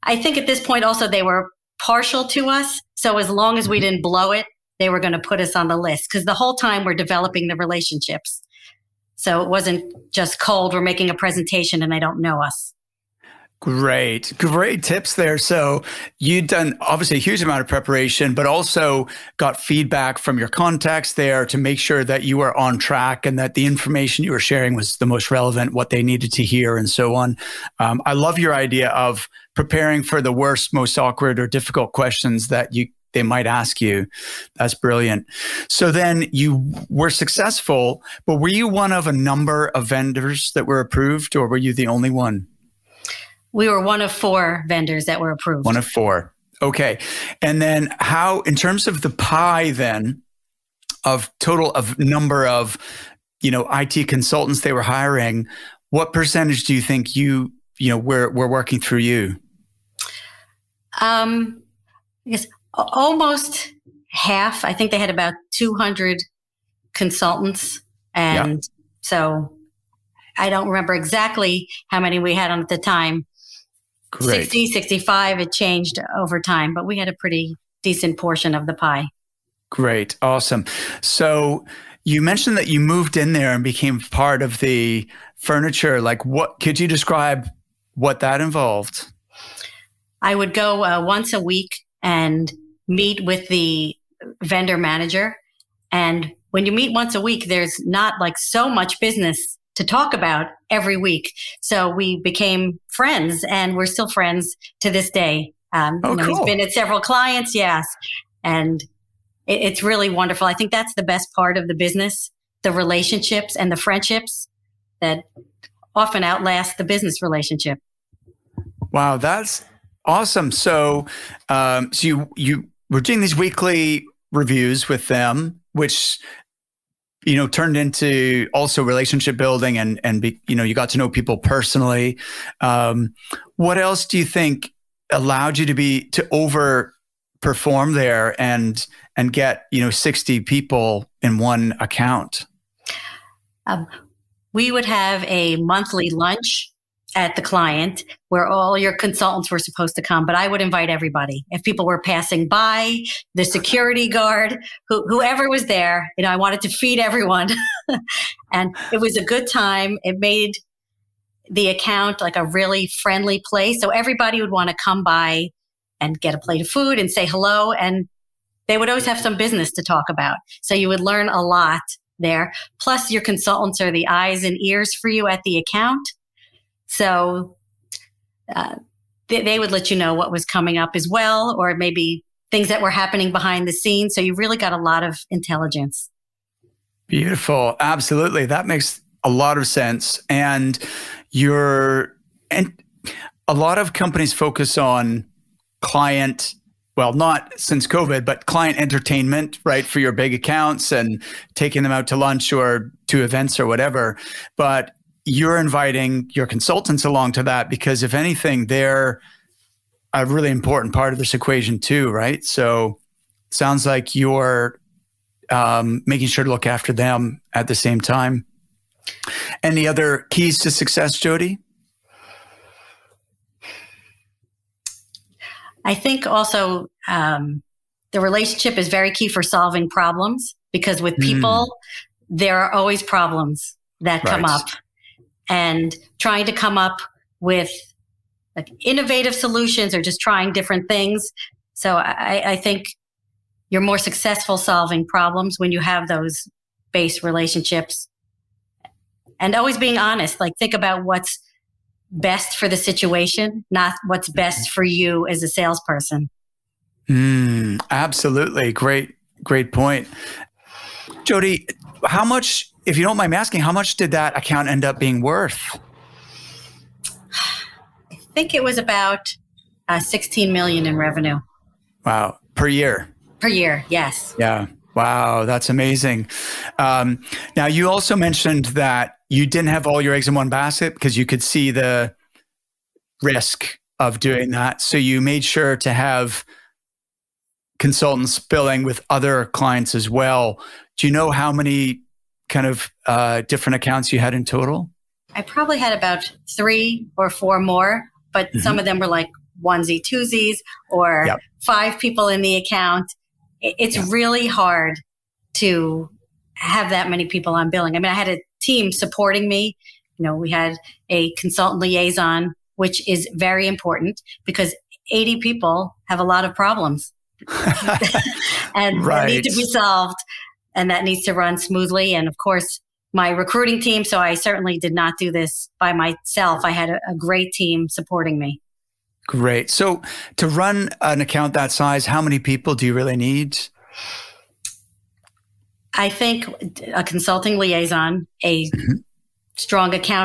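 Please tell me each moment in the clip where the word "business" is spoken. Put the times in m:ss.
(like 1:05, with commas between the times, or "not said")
1:39, 1:51, 1:56, 2:49.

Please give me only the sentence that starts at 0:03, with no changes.
didn't blow it, they were going to put us on the list because the whole time we're developing the relationships.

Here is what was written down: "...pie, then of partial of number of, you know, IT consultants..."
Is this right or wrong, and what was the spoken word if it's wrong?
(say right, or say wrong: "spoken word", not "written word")
wrong: "total", not "partial".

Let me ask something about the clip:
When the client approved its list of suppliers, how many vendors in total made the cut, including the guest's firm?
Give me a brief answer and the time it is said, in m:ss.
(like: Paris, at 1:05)
4, at 0:43.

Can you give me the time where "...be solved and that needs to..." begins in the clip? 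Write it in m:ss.
5:19.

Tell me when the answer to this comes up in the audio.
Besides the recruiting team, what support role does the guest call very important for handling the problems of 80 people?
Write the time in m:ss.
5:11.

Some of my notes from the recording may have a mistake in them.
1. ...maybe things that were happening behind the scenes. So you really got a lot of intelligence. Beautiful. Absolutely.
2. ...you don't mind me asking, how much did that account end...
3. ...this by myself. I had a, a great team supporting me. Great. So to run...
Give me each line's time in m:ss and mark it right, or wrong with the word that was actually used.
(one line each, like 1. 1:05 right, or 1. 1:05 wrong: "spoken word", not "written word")
1. 3:01 right
2. 4:22 right
3. 5:25 right.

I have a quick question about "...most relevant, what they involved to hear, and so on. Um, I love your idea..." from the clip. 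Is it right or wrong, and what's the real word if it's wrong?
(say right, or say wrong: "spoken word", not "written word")
wrong: "needed", not "involved".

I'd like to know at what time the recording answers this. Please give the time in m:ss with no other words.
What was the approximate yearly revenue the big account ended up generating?
4:29.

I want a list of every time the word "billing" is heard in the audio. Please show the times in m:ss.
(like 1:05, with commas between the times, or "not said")
4:48, 5:07.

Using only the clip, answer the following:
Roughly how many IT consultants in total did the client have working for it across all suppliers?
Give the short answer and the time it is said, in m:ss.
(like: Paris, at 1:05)
200, at 1:05.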